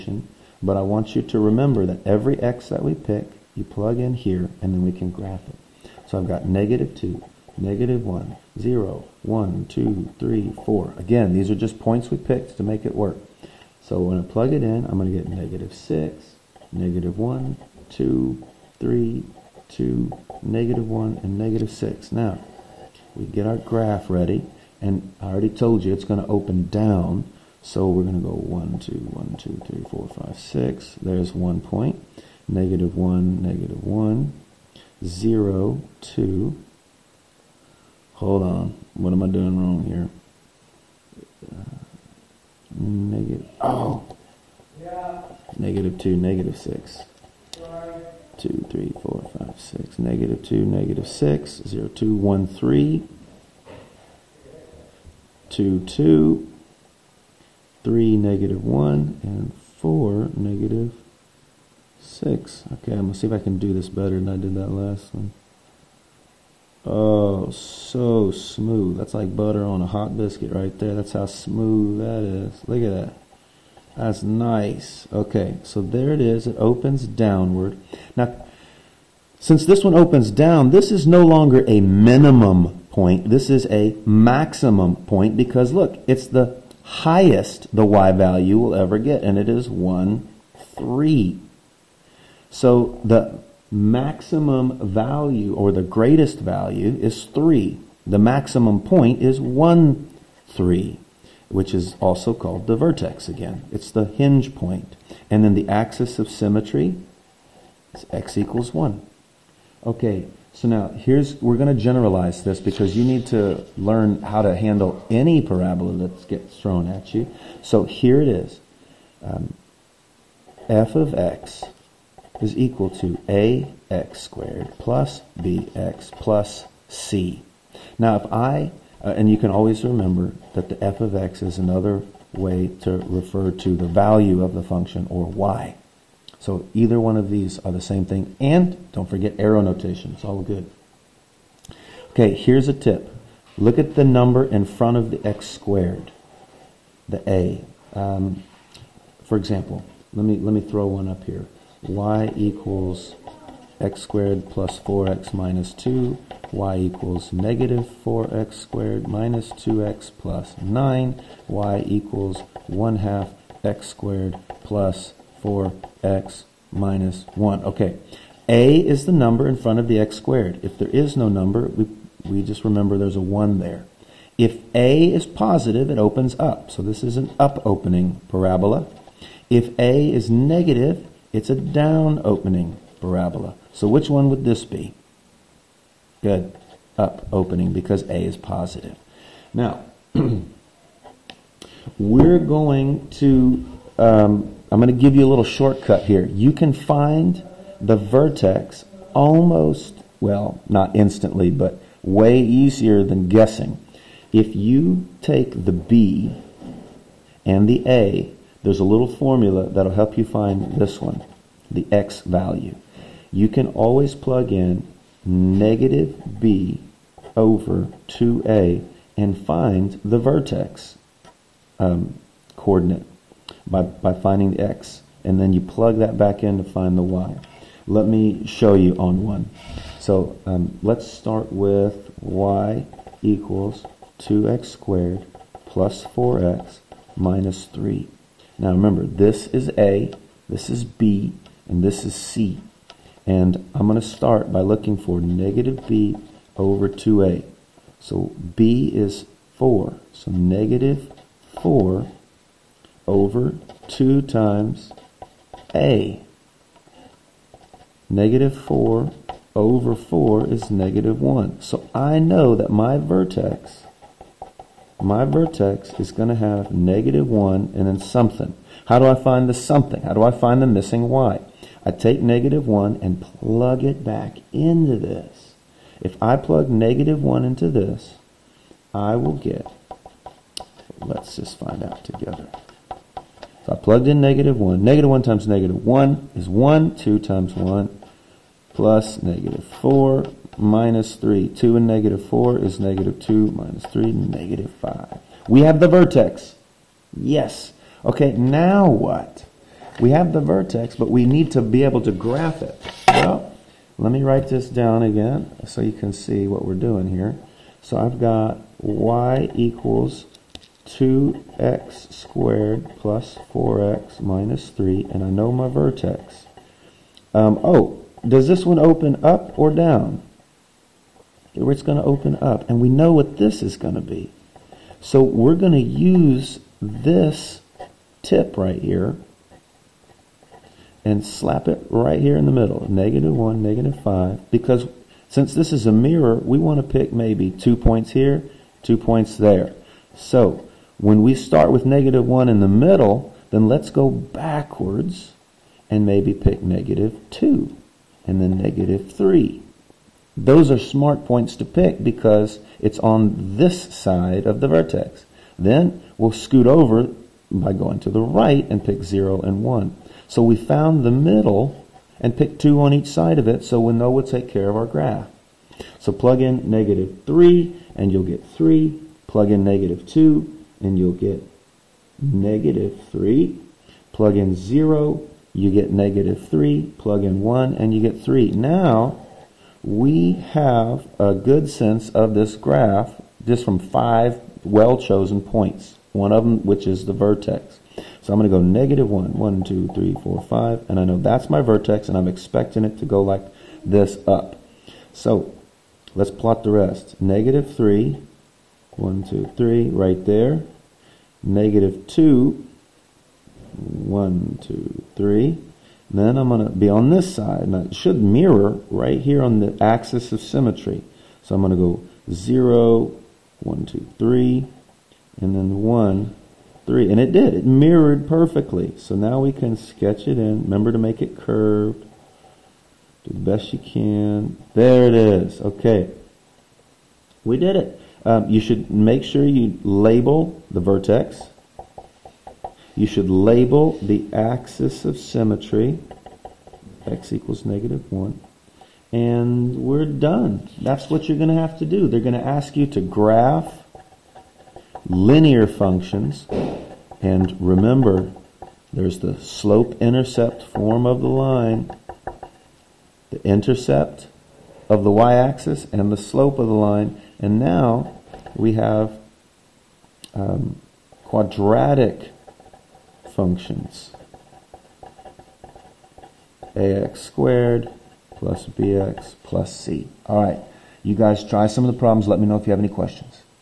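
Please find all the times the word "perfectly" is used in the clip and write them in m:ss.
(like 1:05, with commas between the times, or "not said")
6:58.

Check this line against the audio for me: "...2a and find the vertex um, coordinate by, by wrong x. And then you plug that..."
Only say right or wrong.
wrong.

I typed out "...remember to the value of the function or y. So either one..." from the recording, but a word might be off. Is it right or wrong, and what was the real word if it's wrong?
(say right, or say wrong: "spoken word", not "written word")
wrong: "refer", not "remember".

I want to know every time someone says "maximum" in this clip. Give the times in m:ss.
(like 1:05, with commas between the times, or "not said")
1:24, 1:33, 1:38.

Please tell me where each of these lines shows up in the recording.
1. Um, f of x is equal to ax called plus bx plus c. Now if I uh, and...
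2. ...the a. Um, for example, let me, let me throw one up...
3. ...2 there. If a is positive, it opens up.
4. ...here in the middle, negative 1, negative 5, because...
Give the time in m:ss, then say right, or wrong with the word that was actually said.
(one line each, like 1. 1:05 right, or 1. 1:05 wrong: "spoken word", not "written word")
1. 1:59 wrong: "squared", not "called"
2. 2:27 right
3. 2:53 wrong: "1", not "2"
4. 5:32 right.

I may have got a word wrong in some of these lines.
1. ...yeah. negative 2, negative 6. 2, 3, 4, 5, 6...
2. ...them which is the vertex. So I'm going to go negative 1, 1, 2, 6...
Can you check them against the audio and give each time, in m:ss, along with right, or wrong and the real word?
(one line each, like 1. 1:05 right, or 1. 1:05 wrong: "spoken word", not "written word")
1. 0:44 right
2. 6:26 wrong: "3", not "6".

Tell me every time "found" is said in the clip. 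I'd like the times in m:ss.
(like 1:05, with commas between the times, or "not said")
6:00.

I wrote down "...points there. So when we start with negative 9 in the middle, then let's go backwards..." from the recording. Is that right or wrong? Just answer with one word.
wrong.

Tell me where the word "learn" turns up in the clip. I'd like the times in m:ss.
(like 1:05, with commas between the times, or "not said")
1:53.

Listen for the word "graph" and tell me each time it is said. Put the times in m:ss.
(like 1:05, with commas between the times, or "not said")
0:05, 0:23, 5:02, 6:04, 6:22, 7:23.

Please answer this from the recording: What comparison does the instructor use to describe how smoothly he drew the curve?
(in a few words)
butter on a hot biscuit.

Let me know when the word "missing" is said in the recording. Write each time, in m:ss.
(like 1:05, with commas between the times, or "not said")
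4:30.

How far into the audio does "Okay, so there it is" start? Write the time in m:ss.
1:15.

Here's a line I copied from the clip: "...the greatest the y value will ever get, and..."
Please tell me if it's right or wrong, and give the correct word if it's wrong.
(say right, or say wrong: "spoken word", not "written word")
wrong: "highest", not "greatest".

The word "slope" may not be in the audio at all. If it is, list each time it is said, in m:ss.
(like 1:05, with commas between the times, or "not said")
7:29, 7:36.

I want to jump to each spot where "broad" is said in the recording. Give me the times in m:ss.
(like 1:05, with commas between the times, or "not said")
not said.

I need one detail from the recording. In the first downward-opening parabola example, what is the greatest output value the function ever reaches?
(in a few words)
3.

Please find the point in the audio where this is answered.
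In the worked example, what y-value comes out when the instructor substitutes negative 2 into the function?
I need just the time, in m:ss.
6:09.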